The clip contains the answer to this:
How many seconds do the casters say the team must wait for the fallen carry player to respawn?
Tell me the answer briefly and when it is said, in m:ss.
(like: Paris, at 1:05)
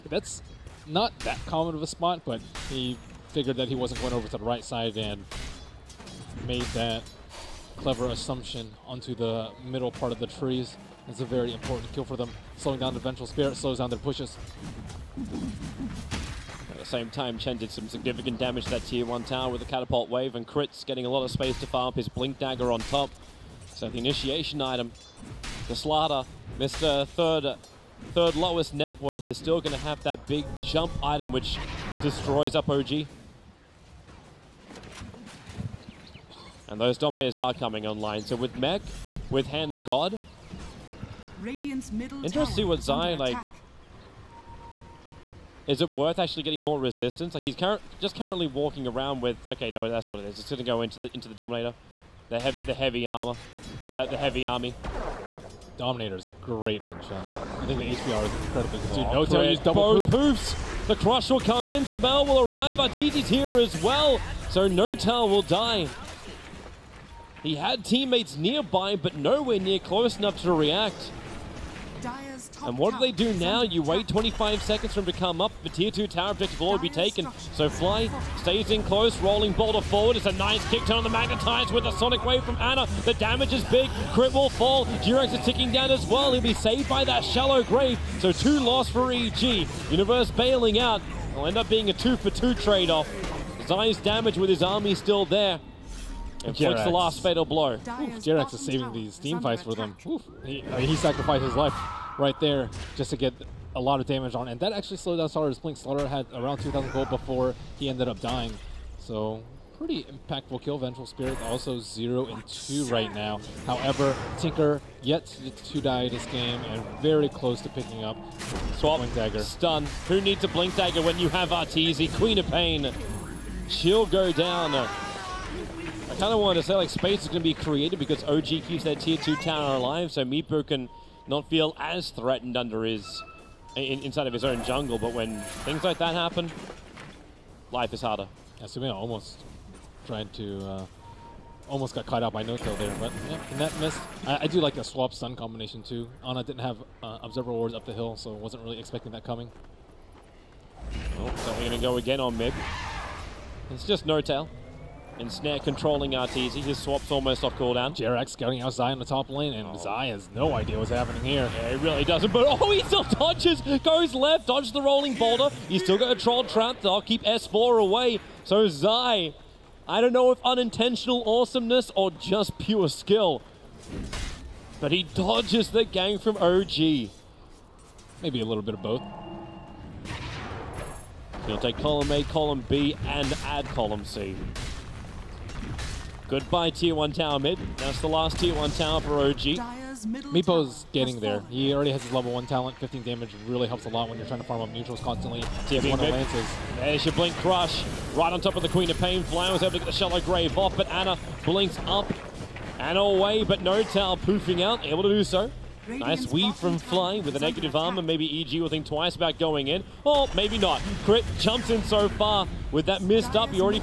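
25, at 1:14.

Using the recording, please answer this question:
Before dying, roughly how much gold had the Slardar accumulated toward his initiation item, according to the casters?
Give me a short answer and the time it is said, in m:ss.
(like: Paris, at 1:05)
2,000, at 1:46.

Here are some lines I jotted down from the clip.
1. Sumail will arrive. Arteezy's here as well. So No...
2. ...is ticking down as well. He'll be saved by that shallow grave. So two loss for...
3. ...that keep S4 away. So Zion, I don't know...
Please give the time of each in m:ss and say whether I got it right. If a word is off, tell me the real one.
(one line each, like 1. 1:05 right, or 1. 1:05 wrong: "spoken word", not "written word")
1. 1:01 right
2. 1:25 right
3. 2:46 wrong: "Zai", not "Zion".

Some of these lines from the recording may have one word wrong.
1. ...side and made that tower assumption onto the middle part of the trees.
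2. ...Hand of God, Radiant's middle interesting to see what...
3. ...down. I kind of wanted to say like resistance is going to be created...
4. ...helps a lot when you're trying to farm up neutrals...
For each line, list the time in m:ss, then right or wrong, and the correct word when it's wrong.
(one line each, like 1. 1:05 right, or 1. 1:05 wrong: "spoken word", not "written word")
1. 0:04 wrong: "clever", not "tower"
2. 0:39 right
3. 2:04 wrong: "space", not "resistance"
4. 3:13 right.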